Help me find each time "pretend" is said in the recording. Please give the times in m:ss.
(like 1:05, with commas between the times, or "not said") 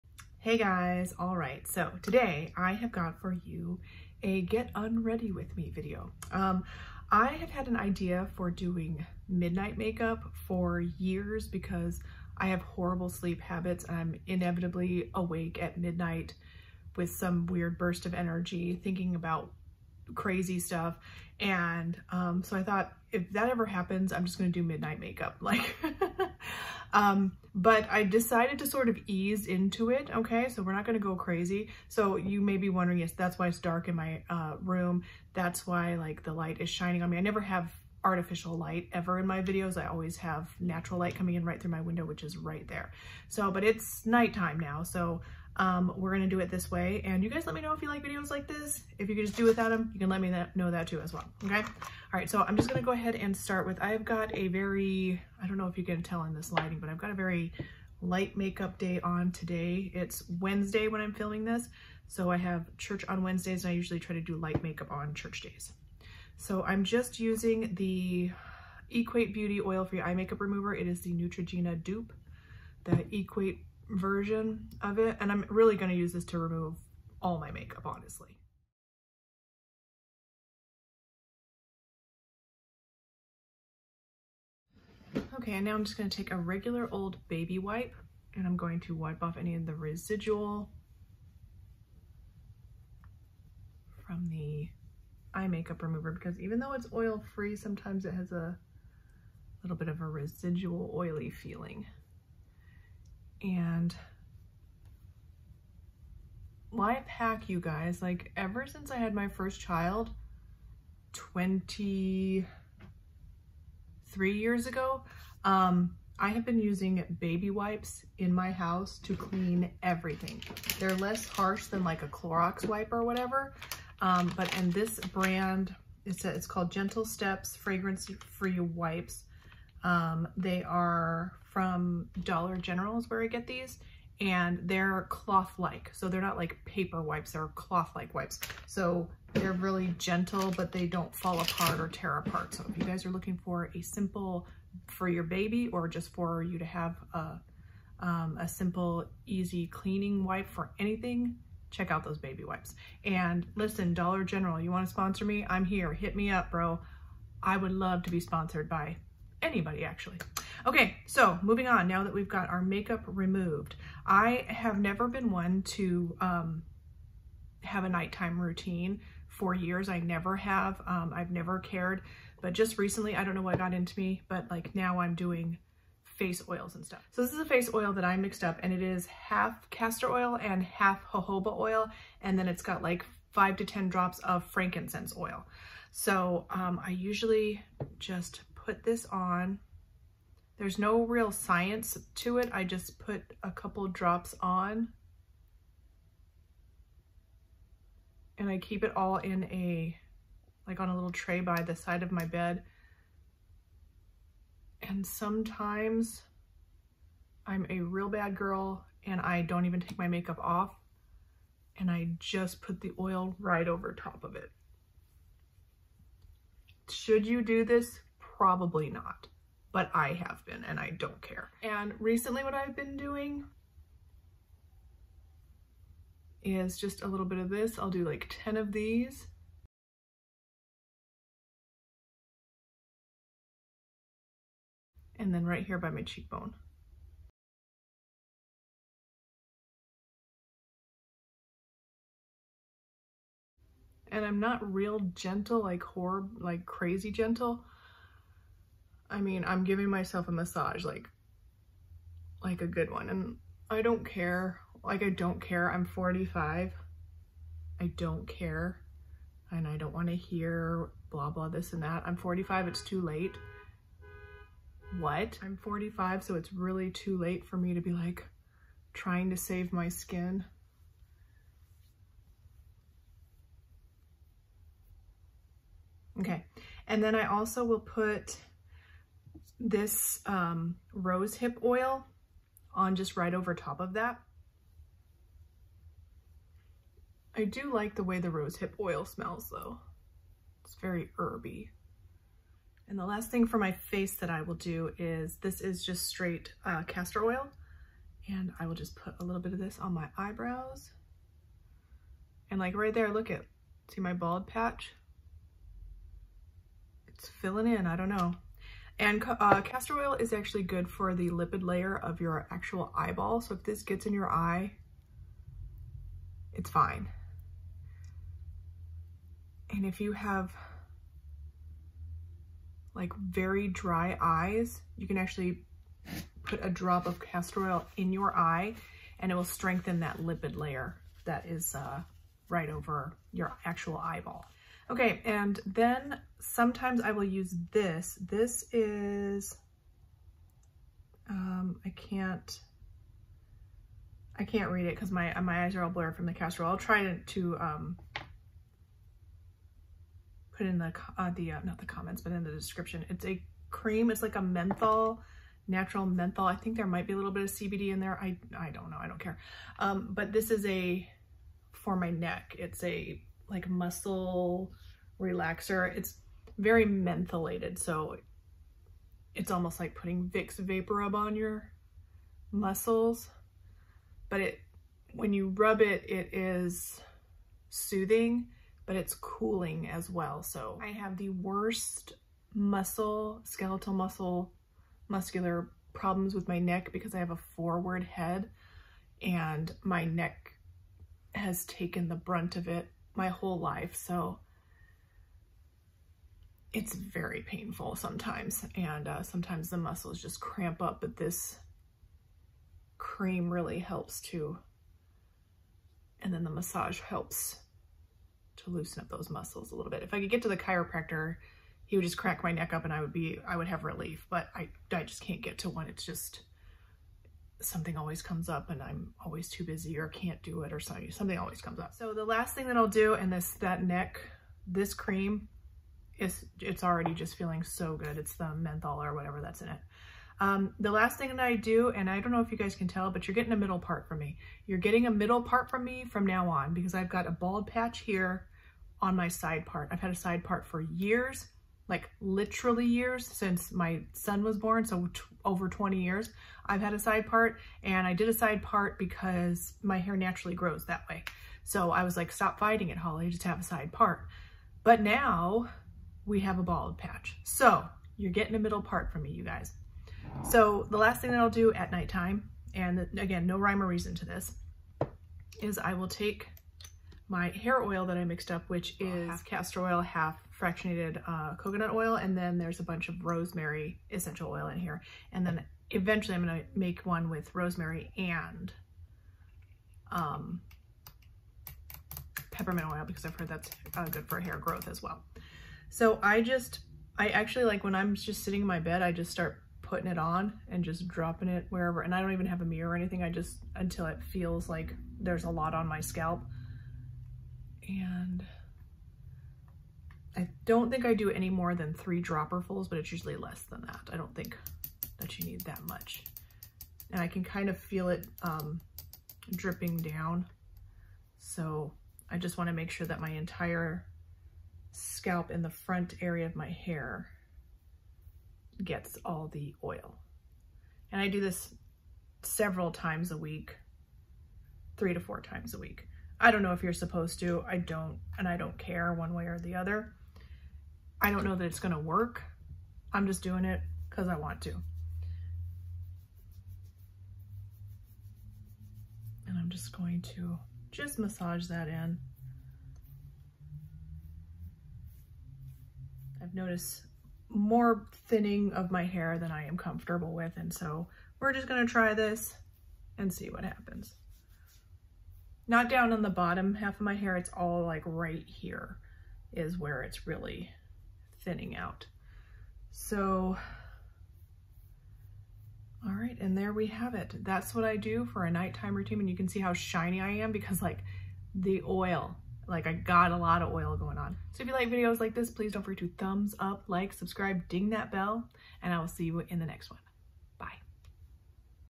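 not said.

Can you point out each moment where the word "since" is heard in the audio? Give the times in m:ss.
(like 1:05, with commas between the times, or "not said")
1:48, 7:23.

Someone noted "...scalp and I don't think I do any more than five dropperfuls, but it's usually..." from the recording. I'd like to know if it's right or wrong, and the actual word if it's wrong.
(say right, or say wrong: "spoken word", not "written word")
wrong: "three", not "five".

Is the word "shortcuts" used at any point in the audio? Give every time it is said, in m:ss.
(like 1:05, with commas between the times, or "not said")
not said.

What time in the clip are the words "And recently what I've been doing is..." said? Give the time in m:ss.
3:41.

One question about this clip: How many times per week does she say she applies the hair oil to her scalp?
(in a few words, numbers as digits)
3 to 4.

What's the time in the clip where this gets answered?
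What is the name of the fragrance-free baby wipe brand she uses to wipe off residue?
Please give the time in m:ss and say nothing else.
2:06.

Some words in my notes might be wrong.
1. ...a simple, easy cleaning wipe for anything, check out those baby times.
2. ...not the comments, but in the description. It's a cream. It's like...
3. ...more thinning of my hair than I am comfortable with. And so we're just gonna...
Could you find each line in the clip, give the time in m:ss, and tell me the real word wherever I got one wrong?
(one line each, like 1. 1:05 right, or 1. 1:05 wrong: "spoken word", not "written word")
1. 2:28 wrong: "wipes", not "times"
2. 5:51 right
3. 9:07 right.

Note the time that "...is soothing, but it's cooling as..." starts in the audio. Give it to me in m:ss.
6:16.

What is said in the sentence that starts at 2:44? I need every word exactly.
I have never been one to um, have a nighttime routine for years.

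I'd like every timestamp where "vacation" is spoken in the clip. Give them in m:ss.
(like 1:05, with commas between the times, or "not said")
not said.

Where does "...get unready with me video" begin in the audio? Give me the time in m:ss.
0:04.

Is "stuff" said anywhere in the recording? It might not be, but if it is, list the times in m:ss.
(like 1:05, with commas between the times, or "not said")
0:20, 2:56.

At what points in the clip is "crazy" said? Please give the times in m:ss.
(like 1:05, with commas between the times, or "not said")
0:20, 0:31, 4:06.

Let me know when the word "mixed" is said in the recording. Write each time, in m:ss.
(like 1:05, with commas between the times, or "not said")
2:58, 7:48.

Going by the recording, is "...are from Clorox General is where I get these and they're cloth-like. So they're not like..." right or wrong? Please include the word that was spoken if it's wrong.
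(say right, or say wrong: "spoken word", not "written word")
wrong: "Dollar", not "Clorox".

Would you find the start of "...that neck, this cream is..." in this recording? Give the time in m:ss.
7:03.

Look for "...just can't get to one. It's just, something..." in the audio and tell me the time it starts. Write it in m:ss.
6:55.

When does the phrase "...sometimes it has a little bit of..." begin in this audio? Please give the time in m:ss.
1:37.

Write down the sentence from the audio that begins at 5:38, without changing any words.
This is, um, I can't, I can't read it because my my eyes are all blurred from the castor oil.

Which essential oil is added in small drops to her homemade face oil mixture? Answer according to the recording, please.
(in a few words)
frankincense.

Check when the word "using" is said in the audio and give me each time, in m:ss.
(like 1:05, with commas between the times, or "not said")
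1:07, 1:56.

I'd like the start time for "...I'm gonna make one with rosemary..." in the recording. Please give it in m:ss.
7:56.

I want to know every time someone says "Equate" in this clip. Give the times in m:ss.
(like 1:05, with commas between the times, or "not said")
1:08, 1:13.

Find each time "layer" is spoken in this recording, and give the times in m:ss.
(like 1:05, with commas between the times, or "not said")
5:11, 5:30.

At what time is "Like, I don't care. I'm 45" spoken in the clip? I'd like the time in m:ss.
4:14.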